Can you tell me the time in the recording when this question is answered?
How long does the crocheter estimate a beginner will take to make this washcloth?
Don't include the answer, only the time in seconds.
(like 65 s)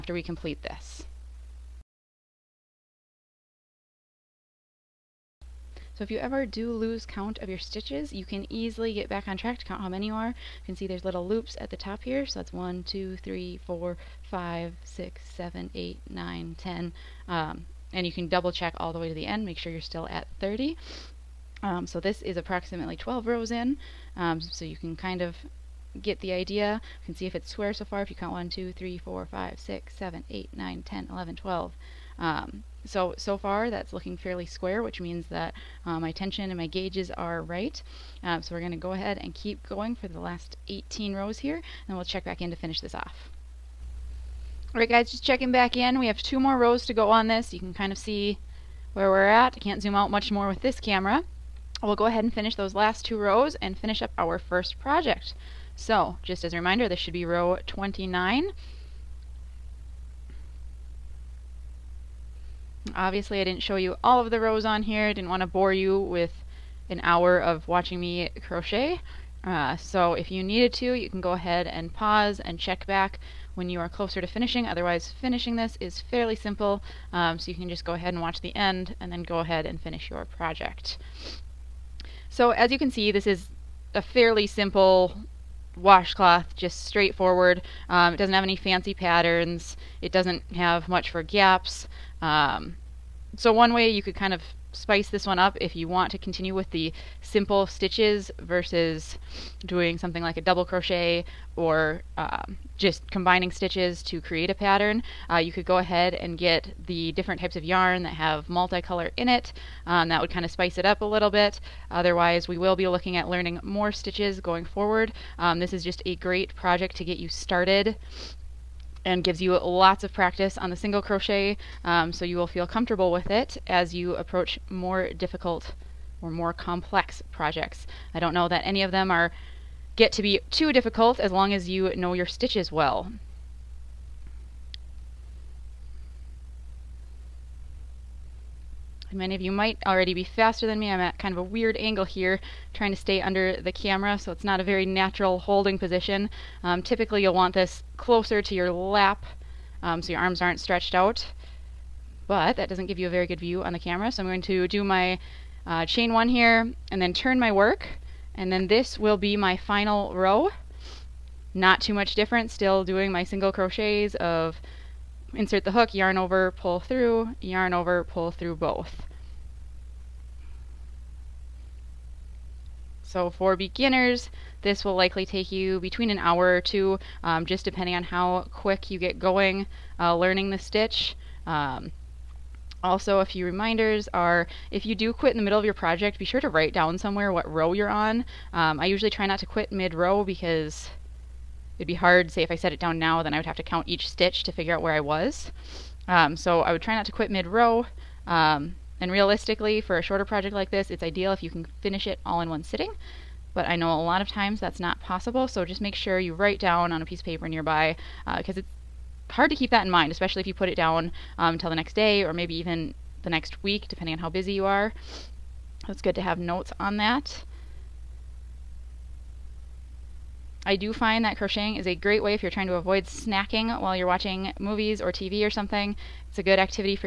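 176 s.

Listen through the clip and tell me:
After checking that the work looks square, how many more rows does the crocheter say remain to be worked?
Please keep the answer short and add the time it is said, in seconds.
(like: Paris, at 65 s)
18, at 40 s.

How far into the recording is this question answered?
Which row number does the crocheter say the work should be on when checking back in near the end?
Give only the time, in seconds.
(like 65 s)
57 s.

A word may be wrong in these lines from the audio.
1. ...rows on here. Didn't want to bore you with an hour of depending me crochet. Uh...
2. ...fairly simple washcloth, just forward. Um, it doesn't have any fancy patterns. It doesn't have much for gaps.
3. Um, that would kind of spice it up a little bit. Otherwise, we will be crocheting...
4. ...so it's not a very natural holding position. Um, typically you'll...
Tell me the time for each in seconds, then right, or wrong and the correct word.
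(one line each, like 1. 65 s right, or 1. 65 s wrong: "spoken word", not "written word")
1. 64 s wrong: "watching", not "depending"
2. 84 s wrong: "straightforward", not "forward"
3. 109 s wrong: "looking", not "crocheting"
4. 144 s right.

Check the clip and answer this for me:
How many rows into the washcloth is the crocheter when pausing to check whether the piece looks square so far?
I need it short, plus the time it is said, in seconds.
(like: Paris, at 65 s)
12, at 22 s.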